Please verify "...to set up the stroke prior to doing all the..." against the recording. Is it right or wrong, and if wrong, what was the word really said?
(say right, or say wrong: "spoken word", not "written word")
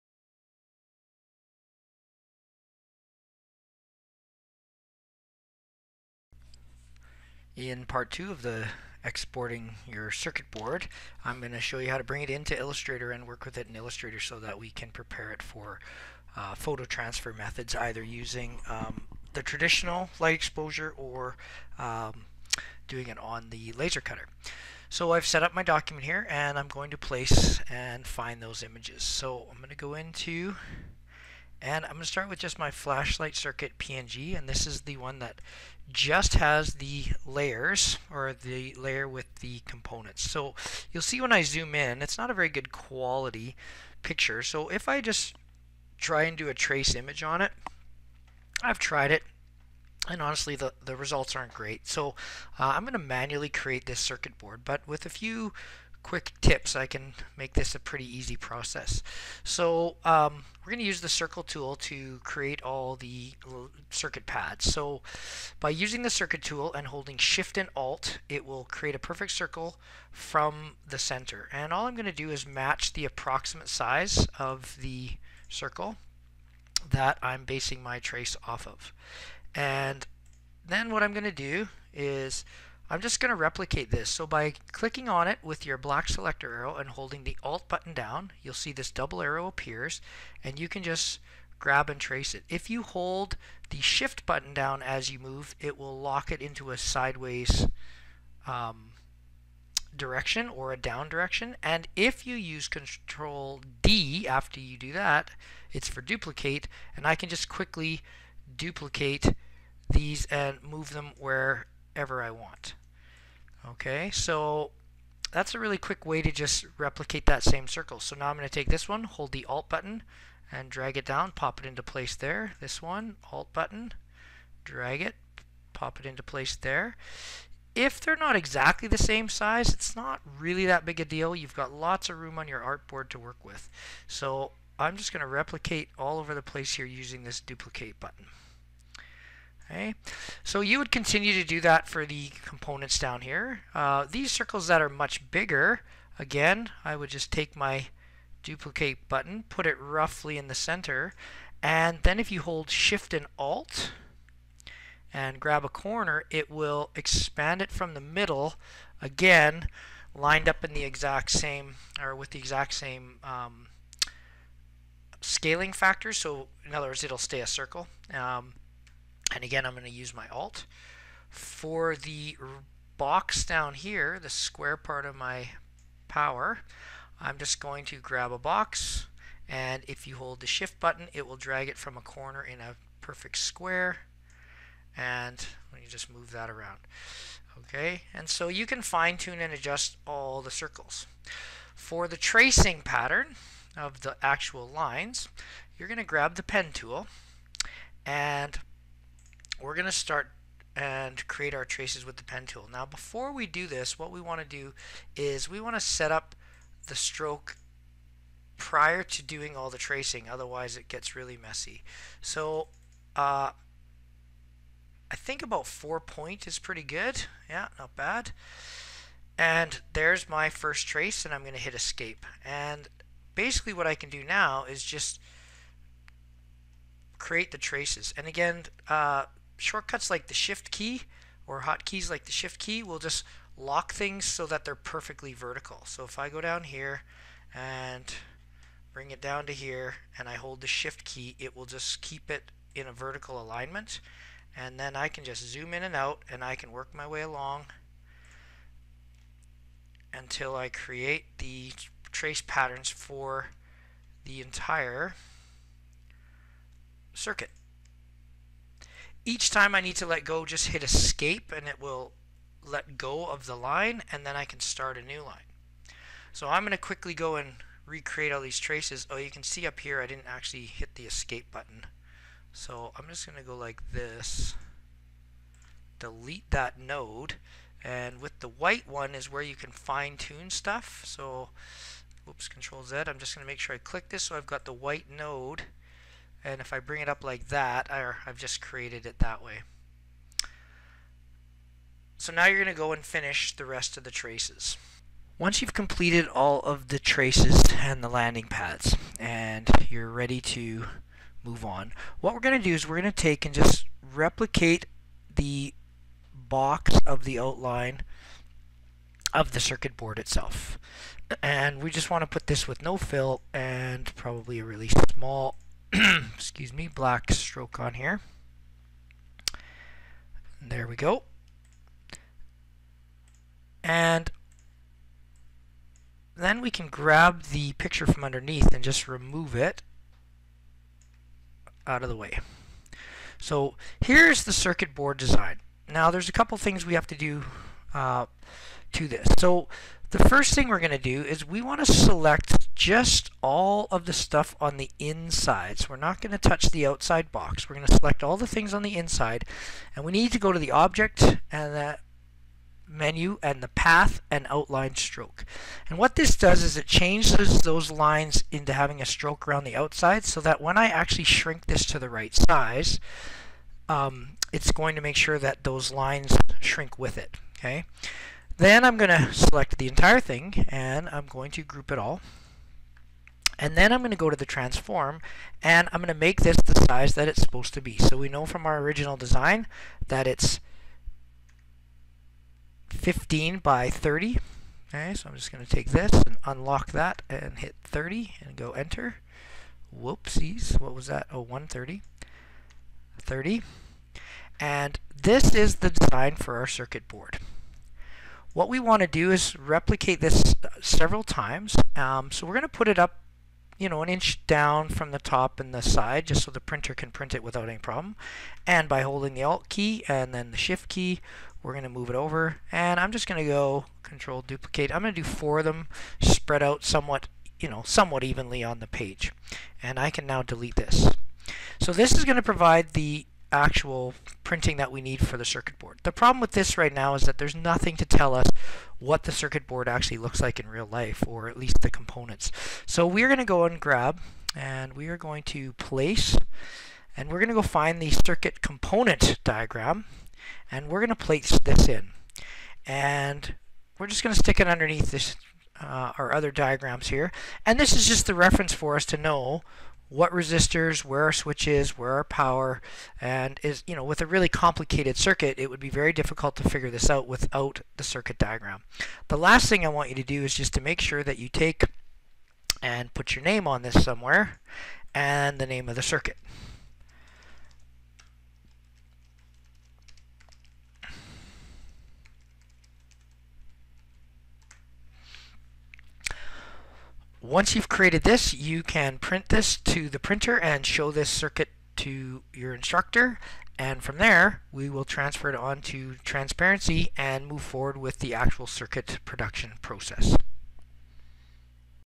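right.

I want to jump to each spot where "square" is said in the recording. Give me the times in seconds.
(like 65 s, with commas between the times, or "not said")
174 s, 183 s.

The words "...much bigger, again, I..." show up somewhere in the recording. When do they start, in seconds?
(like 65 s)
144 s.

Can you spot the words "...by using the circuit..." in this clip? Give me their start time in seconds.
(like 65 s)
65 s.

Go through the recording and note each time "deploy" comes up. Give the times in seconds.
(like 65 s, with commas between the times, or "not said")
not said.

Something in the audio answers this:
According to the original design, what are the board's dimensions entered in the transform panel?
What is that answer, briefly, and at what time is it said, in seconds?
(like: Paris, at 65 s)
15 by 30, at 382 s.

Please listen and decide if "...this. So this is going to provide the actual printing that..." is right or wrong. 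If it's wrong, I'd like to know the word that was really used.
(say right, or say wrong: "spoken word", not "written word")
right.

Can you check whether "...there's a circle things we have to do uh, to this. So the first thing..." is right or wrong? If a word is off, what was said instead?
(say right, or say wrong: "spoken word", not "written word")
wrong: "couple", not "circle".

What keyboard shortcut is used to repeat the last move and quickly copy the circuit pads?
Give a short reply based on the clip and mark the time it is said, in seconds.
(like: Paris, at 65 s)
Control D, at 102 s.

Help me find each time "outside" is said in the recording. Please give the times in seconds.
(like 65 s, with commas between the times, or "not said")
346 s, 359 s.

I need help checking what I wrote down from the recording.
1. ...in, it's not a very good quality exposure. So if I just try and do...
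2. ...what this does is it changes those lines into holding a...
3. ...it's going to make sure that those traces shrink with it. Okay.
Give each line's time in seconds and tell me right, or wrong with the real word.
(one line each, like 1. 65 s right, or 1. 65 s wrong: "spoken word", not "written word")
1. 41 s wrong: "picture", not "exposure"
2. 355 s wrong: "having", not "holding"
3. 364 s wrong: "lines", not "traces".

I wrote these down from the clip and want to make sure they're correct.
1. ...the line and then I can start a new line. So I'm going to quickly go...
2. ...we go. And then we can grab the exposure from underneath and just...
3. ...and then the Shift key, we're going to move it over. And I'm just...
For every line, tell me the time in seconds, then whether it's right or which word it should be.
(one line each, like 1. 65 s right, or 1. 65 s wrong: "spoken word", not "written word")
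1. 263 s right
2. 320 s wrong: "picture", not "exposure"
3. 410 s right.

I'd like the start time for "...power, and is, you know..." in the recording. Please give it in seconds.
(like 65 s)
452 s.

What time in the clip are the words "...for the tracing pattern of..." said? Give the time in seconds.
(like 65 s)
191 s.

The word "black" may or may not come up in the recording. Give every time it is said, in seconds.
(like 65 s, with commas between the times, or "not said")
85 s, 316 s.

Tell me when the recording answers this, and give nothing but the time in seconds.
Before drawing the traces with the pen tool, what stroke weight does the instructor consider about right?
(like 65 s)
215 s.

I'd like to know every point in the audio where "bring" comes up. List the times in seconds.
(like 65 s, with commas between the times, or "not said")
12 s, 238 s, 286 s.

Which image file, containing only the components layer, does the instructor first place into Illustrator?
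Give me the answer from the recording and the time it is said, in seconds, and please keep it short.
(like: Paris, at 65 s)
flashlight circuit PNG, at 32 s.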